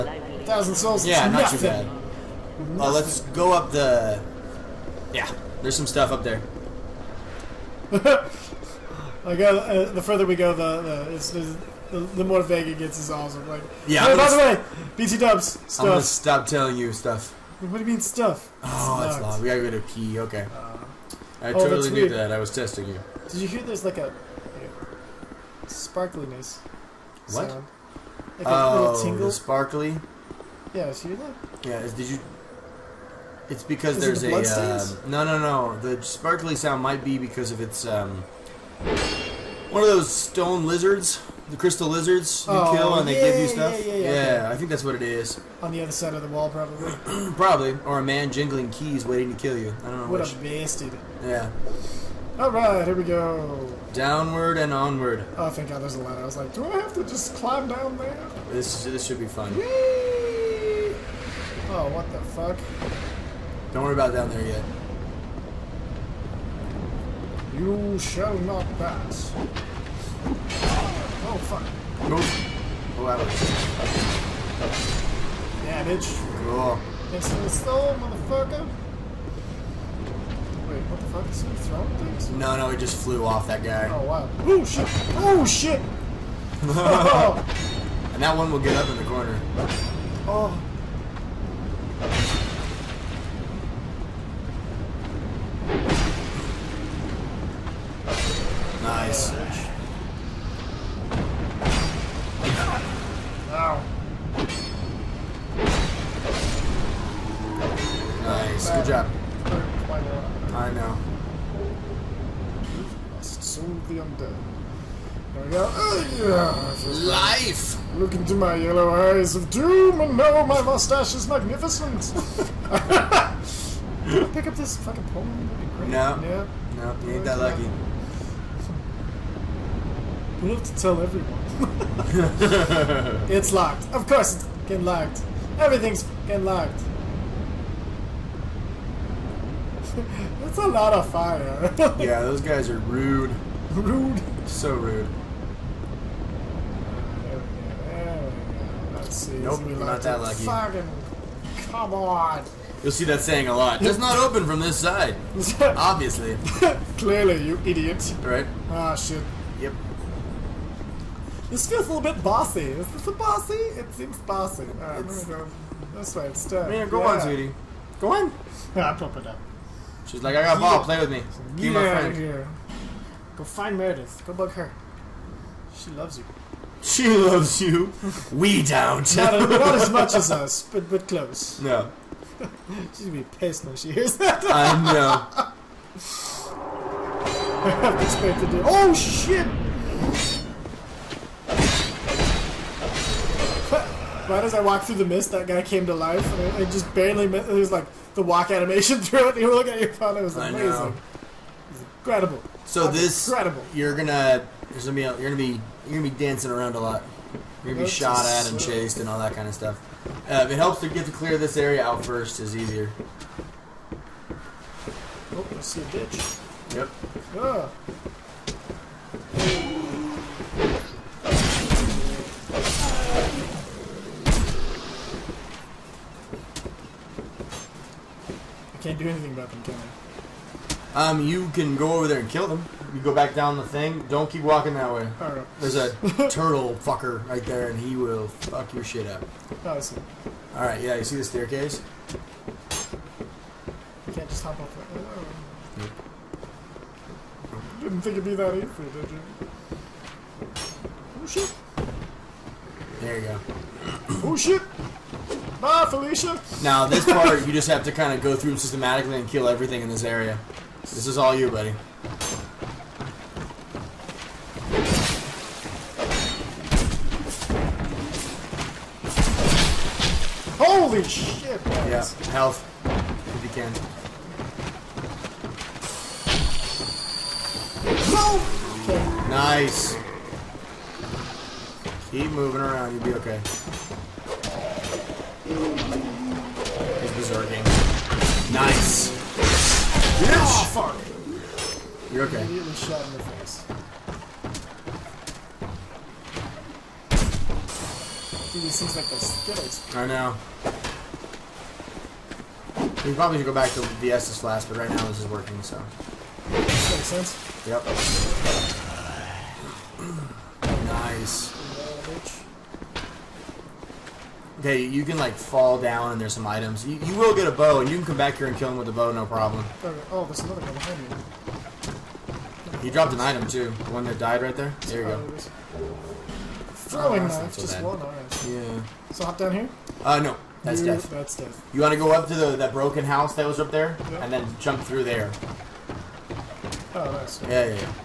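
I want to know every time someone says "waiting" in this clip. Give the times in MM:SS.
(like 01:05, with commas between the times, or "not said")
00:49.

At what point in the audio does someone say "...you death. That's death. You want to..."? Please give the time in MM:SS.
05:30.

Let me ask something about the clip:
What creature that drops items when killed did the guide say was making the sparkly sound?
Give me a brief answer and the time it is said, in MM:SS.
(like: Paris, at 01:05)
crystal lizards, at 00:41.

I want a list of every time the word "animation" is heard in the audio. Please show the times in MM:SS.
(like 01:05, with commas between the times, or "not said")
03:18.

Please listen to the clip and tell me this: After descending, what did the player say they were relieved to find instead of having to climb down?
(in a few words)
a ladder.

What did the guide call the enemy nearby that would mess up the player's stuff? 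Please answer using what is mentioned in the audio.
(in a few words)
turtle fucker.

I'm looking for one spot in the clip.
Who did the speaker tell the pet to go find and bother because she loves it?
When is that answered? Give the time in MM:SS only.
02:53.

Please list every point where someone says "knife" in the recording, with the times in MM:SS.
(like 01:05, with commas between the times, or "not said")
05:27.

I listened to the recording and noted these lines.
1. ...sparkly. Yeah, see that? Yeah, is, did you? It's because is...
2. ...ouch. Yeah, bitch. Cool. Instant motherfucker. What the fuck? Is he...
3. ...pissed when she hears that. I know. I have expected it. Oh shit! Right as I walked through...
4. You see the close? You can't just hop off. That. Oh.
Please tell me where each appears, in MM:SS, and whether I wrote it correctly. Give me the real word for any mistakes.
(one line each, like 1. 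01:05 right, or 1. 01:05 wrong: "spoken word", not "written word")
1. 00:29 right
2. 01:13 right
3. 03:03 right
4. 04:00 wrong: "staircase", not "close".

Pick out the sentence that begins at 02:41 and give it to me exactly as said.
This feels a little bit bossy.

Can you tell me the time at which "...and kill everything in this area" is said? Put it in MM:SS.
04:19.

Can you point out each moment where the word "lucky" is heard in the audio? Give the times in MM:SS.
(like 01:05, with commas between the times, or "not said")
02:07, 02:30.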